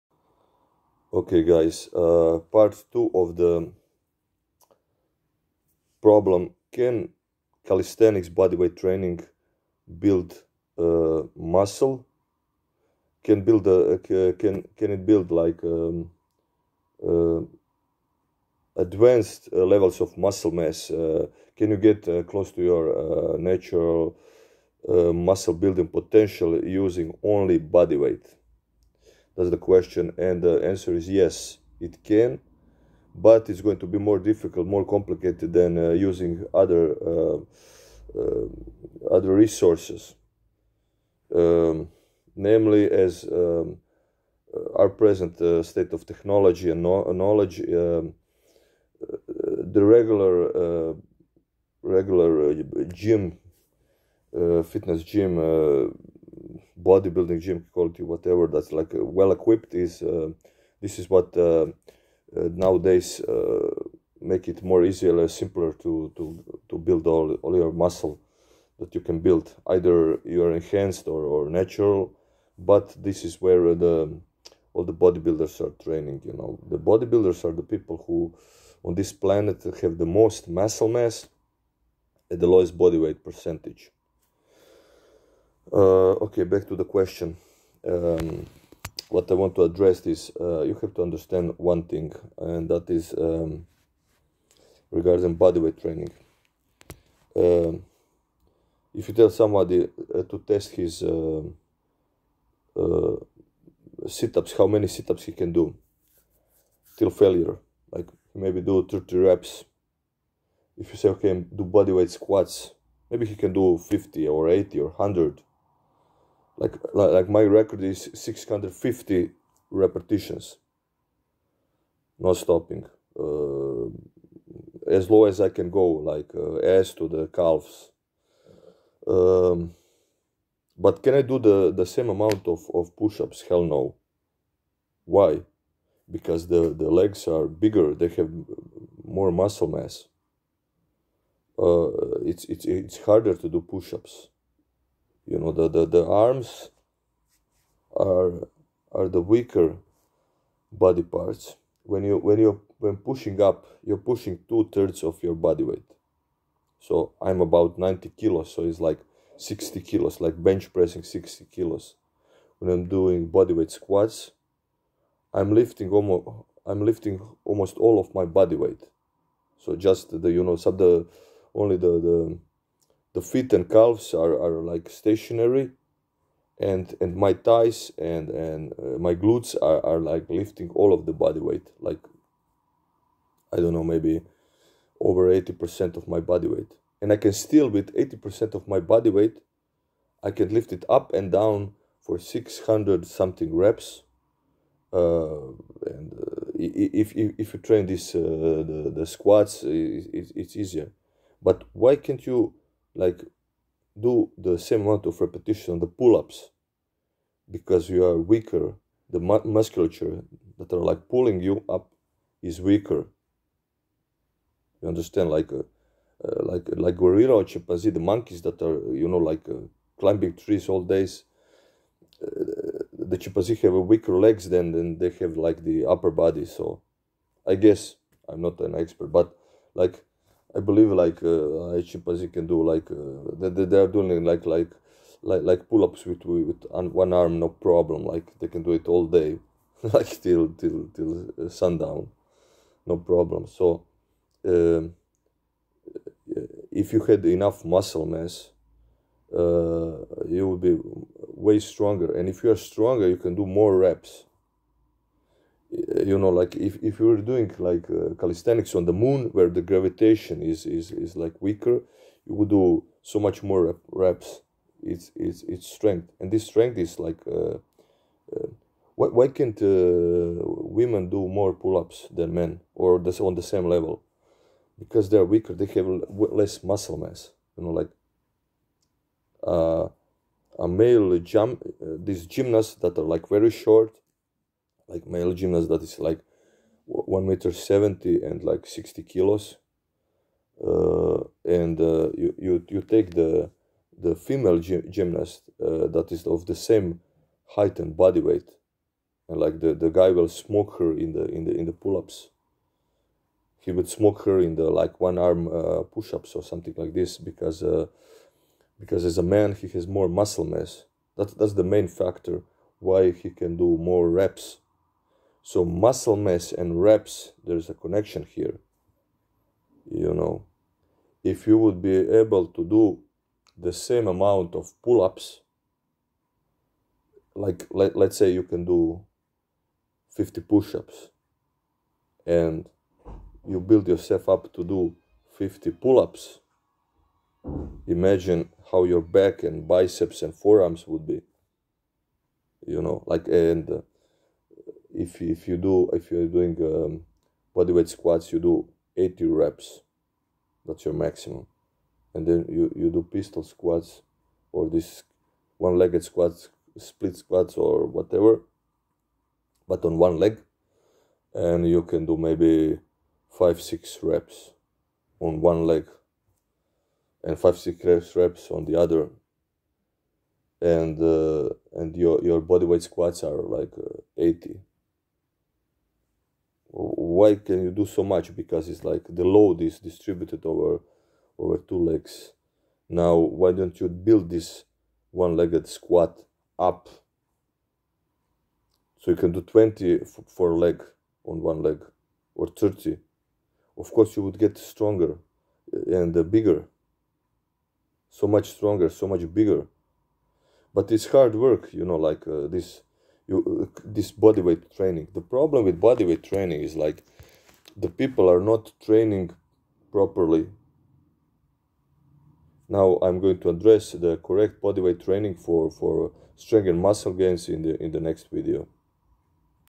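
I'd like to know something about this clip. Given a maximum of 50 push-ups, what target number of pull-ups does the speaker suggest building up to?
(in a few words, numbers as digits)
50 pull-ups.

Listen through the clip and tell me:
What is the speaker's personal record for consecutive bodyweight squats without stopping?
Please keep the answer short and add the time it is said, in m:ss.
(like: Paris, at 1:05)
650 repetitions, at 1:58.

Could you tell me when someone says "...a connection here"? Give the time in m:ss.
5:17.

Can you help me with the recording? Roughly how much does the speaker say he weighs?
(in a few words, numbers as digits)
90 kilos.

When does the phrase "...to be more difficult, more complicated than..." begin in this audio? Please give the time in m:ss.
0:33.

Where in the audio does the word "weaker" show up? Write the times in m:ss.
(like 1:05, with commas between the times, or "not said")
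2:29, 3:28, 3:32, 3:43, 4:21, 4:35.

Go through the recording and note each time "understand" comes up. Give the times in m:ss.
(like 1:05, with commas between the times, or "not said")
1:31, 3:34.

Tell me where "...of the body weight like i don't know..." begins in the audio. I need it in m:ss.
3:00.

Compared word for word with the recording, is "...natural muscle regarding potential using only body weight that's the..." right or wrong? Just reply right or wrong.
wrong.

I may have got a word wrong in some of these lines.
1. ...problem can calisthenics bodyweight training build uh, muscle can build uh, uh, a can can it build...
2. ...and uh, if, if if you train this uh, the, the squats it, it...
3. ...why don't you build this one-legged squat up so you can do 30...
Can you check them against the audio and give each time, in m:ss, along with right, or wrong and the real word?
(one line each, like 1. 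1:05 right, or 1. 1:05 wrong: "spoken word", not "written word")
1. 0:06 right
2. 3:15 right
3. 6:23 wrong: "20", not "30".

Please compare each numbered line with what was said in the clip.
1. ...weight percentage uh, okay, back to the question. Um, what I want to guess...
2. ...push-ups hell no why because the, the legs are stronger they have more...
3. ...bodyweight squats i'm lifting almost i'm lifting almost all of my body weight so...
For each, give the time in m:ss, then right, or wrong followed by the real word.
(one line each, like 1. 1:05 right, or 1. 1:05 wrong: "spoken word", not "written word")
1. 1:22 wrong: "address", not "guess"
2. 2:12 wrong: "bigger", not "stronger"
3. 2:43 right.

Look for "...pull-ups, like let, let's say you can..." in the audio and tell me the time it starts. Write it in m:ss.
5:24.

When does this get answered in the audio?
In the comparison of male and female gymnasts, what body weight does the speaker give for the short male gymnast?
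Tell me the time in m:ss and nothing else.
4:48.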